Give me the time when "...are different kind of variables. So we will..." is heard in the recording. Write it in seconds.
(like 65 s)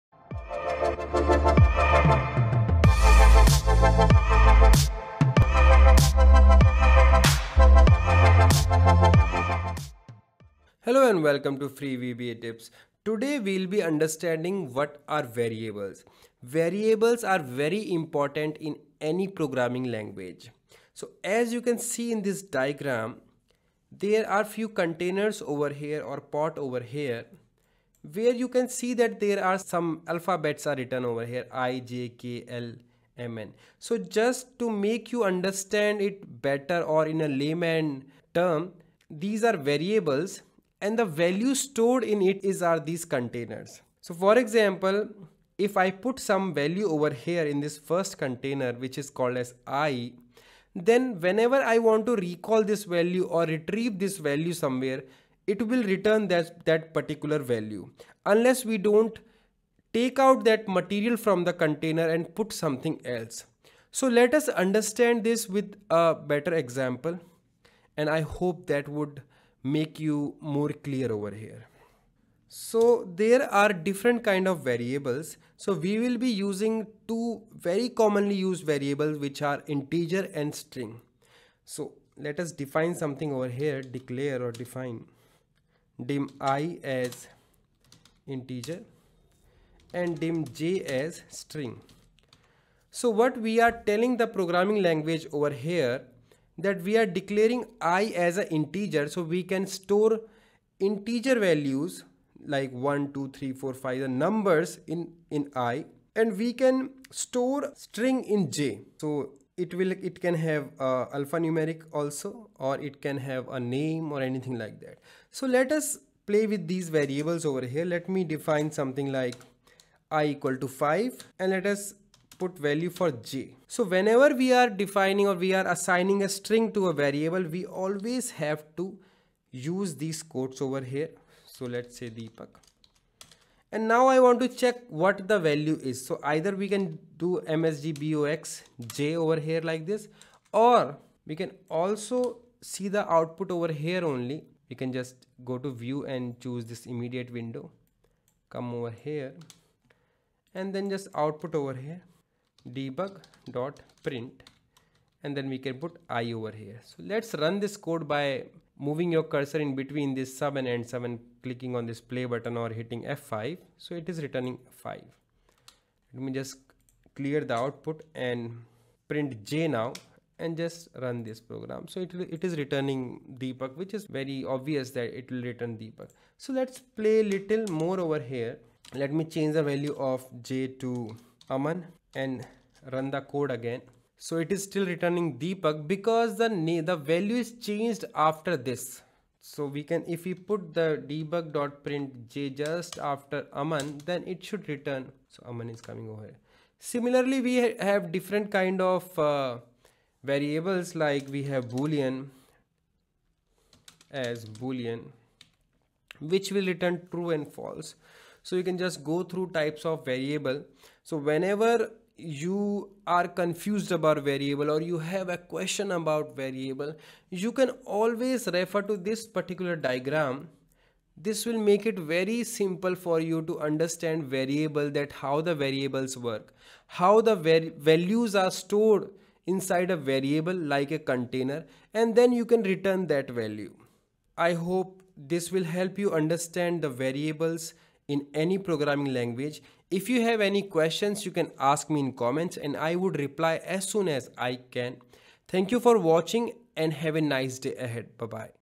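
73 s.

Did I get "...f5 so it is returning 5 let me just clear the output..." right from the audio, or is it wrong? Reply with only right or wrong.
right.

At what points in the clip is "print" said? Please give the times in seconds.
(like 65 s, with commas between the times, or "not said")
154 s, 169 s, 191 s.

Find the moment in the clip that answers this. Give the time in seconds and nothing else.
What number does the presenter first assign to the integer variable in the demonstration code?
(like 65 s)
120 s.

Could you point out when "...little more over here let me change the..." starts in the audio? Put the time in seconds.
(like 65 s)
177 s.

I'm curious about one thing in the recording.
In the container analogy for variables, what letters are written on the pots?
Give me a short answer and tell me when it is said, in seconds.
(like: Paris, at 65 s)
I, J, K, L, M, N, at 31 s.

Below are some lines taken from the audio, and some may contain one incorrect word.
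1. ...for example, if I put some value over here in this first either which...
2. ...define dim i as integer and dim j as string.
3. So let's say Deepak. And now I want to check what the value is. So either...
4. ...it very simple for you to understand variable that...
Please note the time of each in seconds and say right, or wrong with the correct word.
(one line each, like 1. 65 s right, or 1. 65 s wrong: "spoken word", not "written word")
1. 44 s wrong: "container", not "either"
2. 84 s right
3. 131 s right
4. 221 s right.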